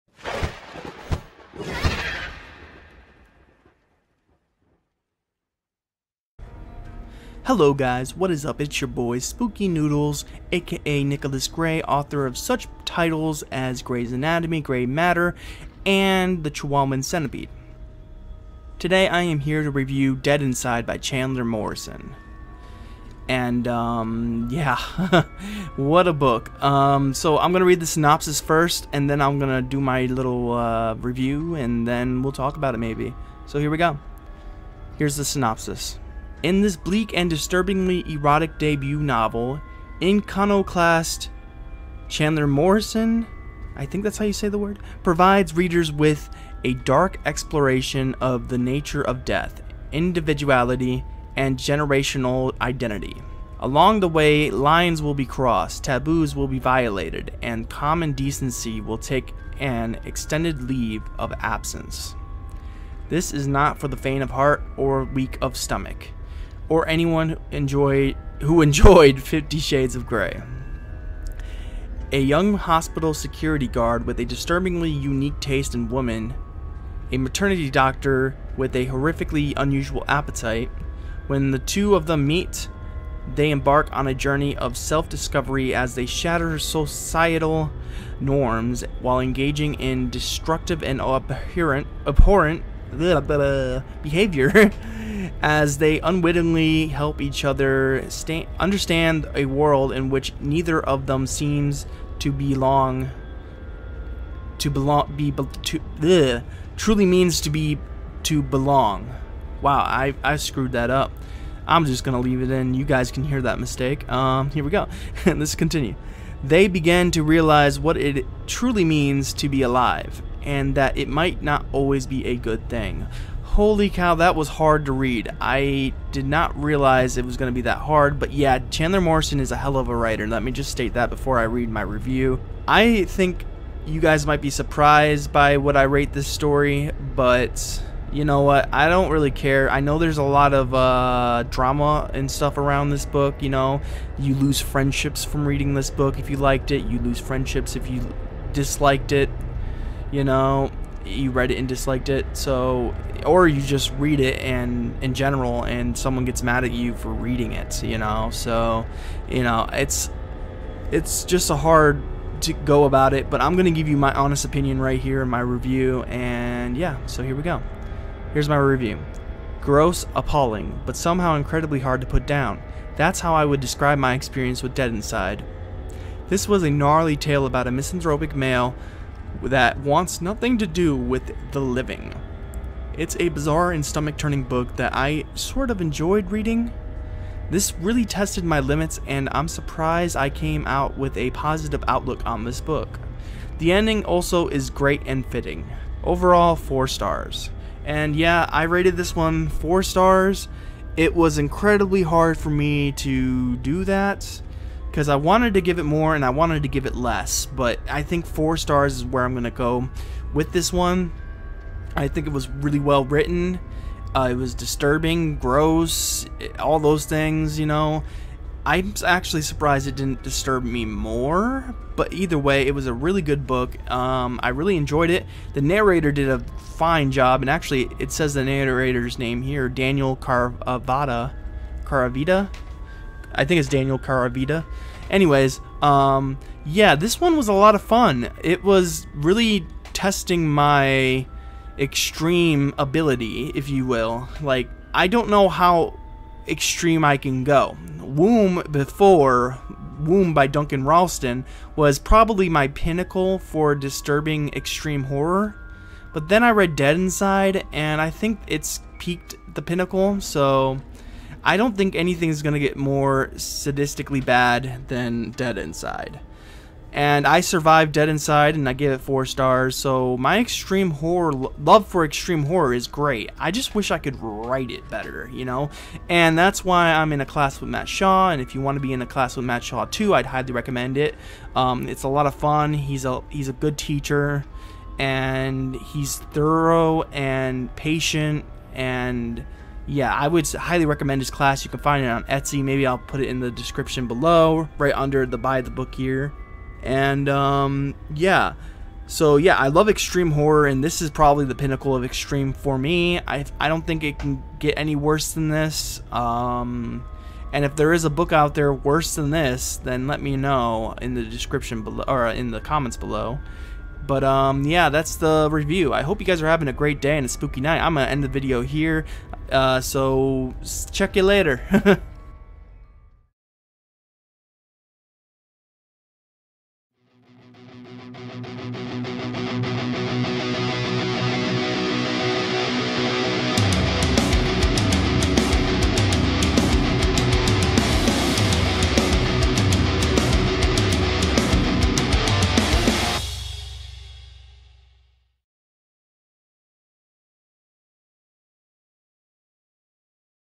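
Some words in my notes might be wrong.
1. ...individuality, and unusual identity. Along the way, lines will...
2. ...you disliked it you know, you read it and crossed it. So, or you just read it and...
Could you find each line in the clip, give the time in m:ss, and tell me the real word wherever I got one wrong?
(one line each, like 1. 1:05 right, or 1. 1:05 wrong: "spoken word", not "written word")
1. 0:49 wrong: "generational", not "unusual"
2. 2:27 wrong: "disliked", not "crossed".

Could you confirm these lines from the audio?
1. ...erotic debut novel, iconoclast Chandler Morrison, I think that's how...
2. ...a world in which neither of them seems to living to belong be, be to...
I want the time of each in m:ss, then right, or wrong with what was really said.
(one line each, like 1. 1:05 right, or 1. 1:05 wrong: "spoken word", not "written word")
1. 0:38 right
2. 1:39 wrong: "belong", not "living".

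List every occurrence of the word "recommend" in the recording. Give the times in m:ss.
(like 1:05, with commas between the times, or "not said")
4:40, 4:50.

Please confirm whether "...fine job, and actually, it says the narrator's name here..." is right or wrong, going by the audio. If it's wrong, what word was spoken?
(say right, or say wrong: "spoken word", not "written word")
right.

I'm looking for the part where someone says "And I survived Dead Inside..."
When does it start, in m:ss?
4:26.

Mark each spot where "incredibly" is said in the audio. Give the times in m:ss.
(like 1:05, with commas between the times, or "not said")
2:51, 3:21.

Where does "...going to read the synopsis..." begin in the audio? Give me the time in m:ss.
0:27.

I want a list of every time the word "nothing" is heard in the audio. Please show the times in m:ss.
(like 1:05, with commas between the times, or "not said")
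3:00.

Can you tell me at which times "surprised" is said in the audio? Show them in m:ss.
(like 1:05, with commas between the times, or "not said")
2:14, 3:09, 3:39.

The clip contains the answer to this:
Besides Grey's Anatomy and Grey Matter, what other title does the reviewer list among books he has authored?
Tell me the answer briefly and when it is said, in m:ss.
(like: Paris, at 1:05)
The Chihuahuan Centipede, at 0:16.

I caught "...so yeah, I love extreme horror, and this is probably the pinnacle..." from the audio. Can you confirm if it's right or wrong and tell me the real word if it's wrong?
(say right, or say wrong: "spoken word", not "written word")
right.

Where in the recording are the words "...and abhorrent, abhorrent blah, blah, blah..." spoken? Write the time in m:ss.
1:30.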